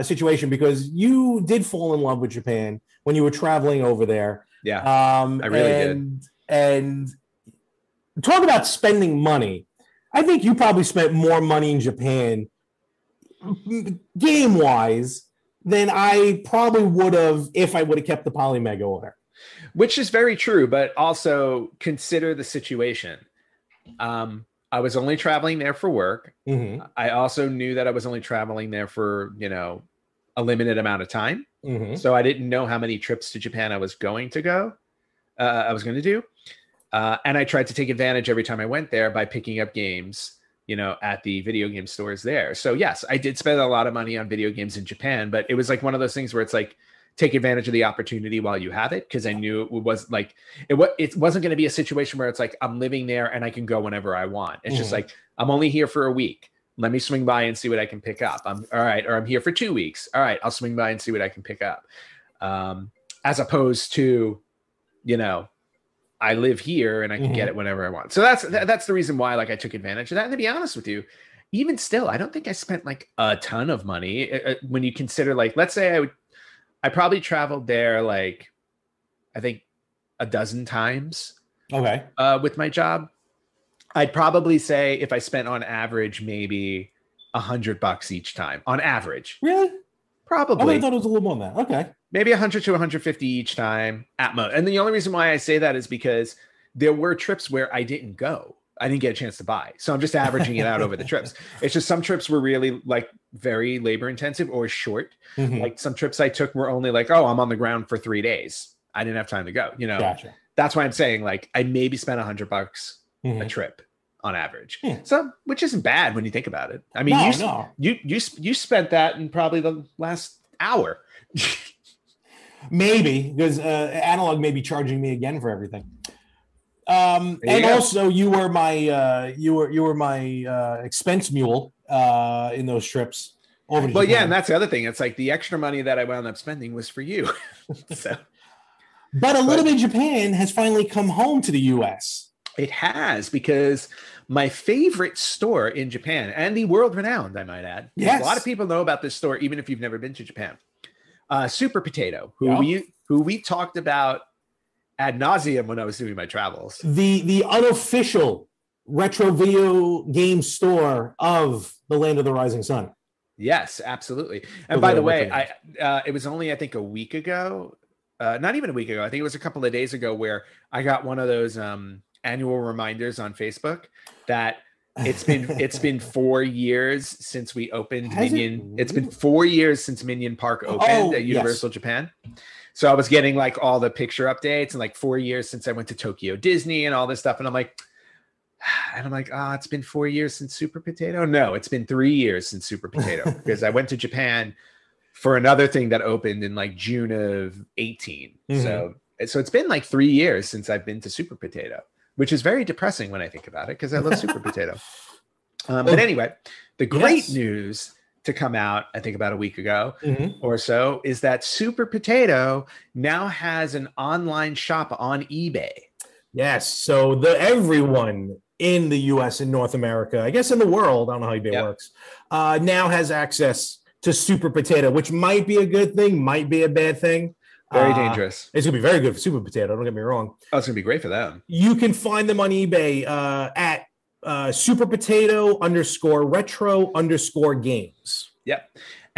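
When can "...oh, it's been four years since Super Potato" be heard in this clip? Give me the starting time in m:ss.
3:09.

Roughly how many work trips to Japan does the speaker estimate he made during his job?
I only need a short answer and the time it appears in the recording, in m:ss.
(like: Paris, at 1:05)
12, at 1:20.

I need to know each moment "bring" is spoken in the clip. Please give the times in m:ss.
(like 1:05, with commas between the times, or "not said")
not said.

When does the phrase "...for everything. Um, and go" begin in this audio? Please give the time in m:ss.
2:05.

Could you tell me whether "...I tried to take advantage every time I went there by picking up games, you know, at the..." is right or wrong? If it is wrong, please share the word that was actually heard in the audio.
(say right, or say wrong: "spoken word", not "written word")
right.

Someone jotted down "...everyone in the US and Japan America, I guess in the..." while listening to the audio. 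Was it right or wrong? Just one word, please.
wrong.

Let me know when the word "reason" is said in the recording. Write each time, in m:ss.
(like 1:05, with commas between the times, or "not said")
1:08, 1:34.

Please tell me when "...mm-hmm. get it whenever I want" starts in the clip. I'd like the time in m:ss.
1:07.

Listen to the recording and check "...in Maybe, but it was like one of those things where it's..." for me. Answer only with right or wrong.
wrong.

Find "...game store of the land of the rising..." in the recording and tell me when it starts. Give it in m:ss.
2:40.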